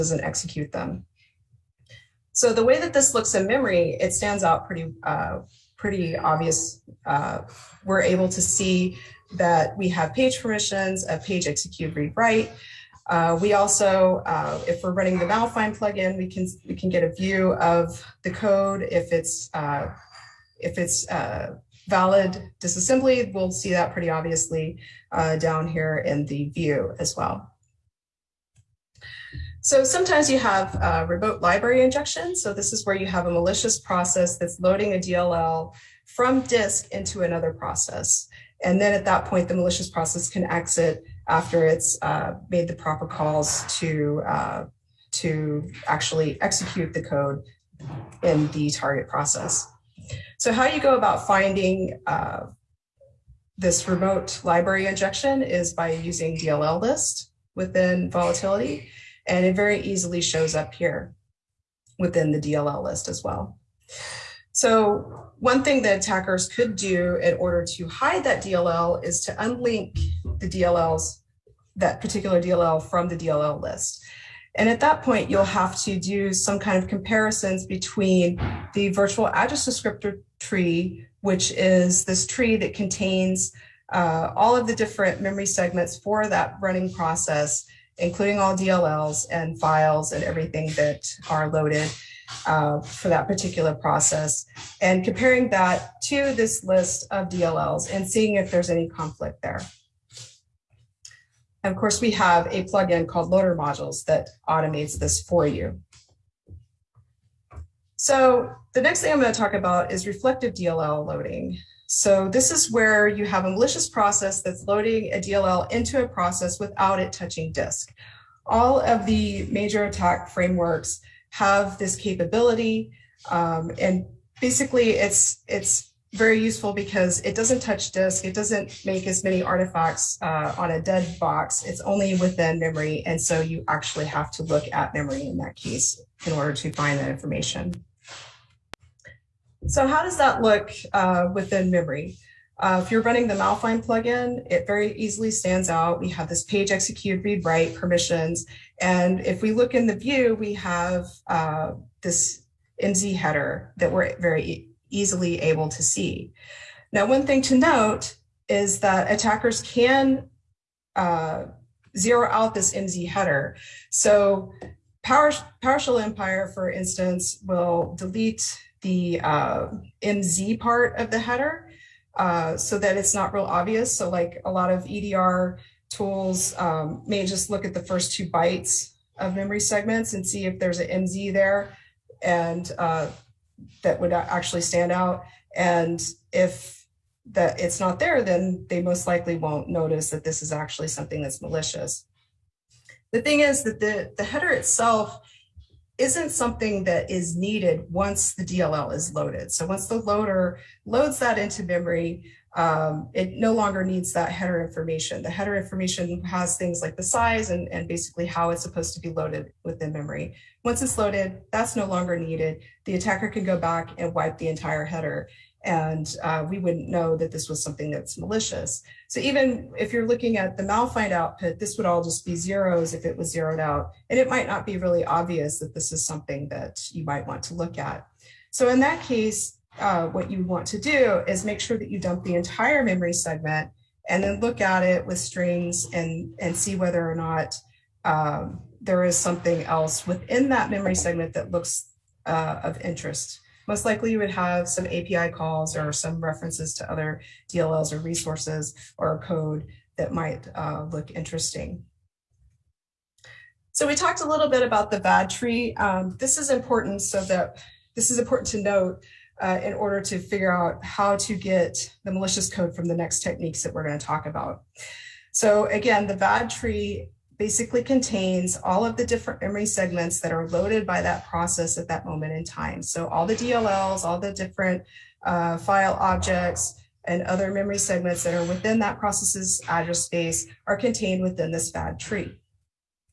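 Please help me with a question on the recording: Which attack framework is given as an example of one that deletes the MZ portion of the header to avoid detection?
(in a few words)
PowerShell Empire.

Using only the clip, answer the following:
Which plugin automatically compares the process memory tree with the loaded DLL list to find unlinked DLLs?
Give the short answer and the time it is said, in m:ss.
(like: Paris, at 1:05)
Loader Modules, at 1:43.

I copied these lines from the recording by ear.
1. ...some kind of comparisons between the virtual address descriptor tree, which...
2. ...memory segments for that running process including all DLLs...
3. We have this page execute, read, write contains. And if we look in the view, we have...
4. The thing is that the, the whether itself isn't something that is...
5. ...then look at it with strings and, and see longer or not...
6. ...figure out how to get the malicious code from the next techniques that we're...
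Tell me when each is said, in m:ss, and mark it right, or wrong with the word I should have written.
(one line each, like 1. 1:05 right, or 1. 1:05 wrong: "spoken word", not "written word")
1. 1:16 right
2. 1:25 right
3. 2:26 wrong: "permissions", not "contains"
4. 3:13 wrong: "header", not "whether"
5. 3:54 wrong: "whether", not "longer"
6. 4:20 right.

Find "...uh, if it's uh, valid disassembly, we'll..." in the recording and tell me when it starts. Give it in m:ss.
0:19.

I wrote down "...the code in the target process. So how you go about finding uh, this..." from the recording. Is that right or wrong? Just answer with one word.
right.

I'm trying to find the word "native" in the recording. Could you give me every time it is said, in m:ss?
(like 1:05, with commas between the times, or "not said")
not said.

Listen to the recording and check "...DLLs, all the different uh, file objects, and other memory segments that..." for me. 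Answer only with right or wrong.
right.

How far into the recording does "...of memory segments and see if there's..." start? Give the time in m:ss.
2:59.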